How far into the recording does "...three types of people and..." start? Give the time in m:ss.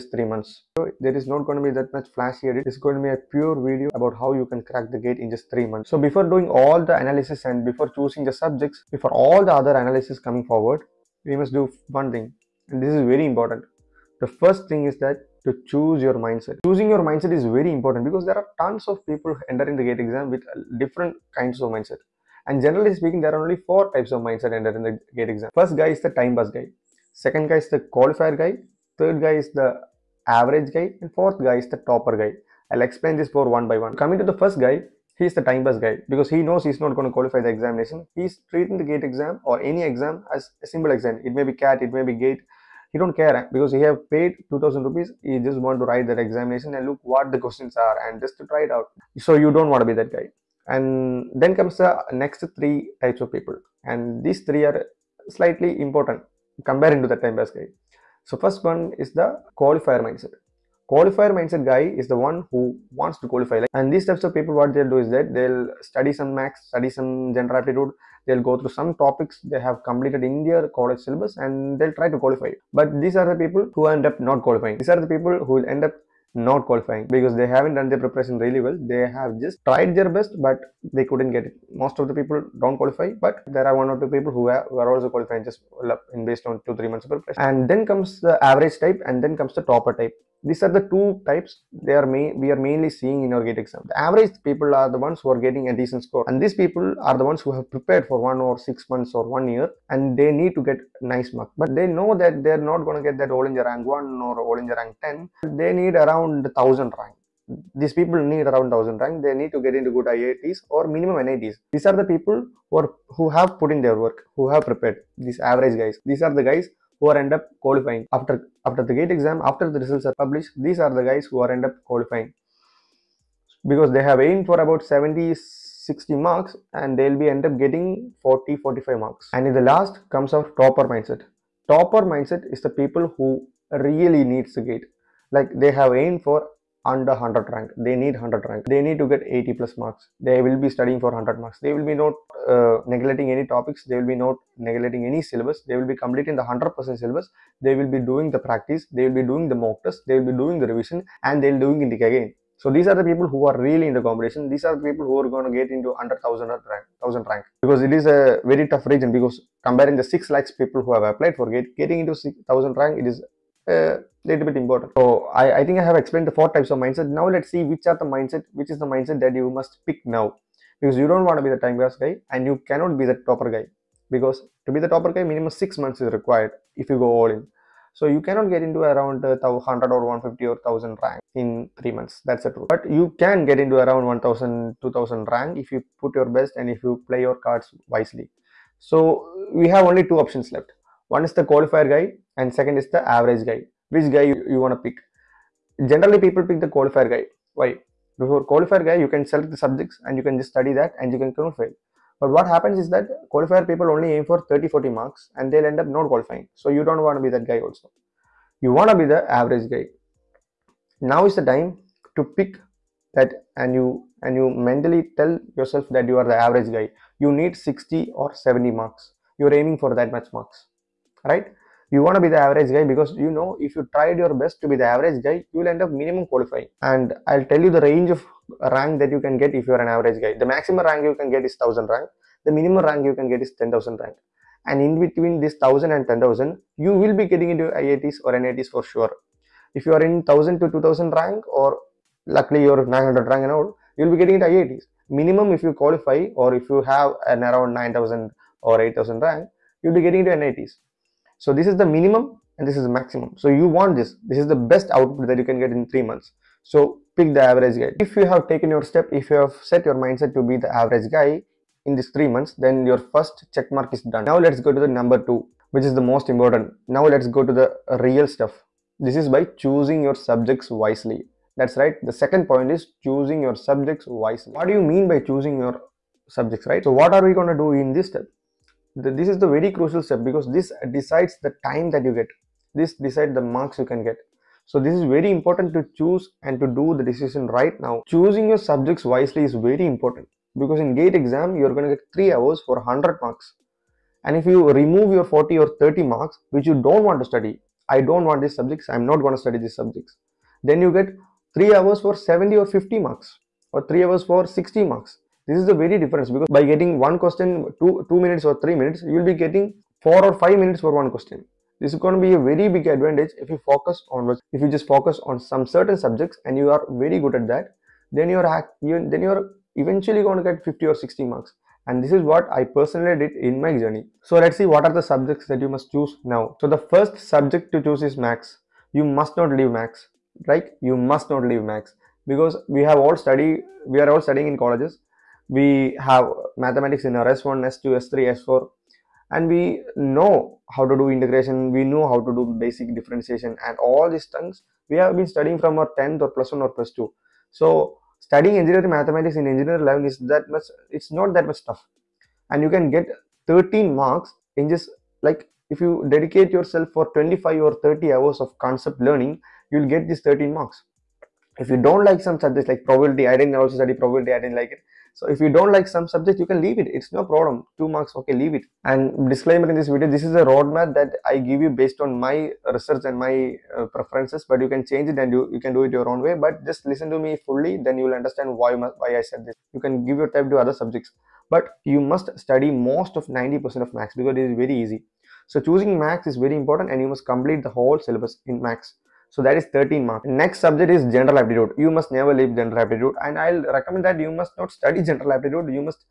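0:52.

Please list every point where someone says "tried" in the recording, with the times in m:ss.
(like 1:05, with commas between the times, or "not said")
1:19, 3:43.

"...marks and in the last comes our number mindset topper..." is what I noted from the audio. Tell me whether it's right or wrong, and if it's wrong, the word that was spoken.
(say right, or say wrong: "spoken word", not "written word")
wrong: "topper", not "number".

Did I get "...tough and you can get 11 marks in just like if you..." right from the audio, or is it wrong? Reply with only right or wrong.
wrong.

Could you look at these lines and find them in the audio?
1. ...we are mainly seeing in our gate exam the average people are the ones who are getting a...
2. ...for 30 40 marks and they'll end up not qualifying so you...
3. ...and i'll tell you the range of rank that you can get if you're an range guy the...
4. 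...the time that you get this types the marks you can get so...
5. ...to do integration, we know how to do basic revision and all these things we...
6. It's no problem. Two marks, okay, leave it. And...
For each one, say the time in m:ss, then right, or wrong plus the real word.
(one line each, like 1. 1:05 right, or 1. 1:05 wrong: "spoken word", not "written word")
1. 1:32 right
2. 3:24 right
3. 3:46 wrong: "average", not "range"
4. 4:41 wrong: "decides", not "types"
5. 5:40 wrong: "differentiation", not "revision"
6. 6:06 right.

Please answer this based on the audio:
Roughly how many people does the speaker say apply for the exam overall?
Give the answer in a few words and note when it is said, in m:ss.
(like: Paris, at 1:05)
6 lakh, at 2:40.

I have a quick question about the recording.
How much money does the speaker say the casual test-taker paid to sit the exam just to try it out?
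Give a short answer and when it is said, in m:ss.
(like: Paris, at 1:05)
2000 rupees, at 0:44.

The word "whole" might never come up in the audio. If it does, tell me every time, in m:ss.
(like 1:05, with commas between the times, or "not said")
6:27.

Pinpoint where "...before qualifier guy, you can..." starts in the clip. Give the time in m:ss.
3:18.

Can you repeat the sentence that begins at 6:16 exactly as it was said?
But just listen to me fully, then you'll understand why, why I said this.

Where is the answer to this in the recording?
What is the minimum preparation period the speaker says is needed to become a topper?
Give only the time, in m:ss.
2:55.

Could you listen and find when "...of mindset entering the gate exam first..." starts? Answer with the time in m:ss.
0:24.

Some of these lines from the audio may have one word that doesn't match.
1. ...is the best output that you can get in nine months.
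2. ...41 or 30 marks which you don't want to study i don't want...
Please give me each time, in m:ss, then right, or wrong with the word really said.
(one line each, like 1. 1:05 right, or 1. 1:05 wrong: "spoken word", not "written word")
1. 4:14 wrong: "three", not "nine"
2. 4:55 wrong: "40", not "41".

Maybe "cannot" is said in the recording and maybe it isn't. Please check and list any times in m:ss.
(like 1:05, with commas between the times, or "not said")
2:52, 2:58.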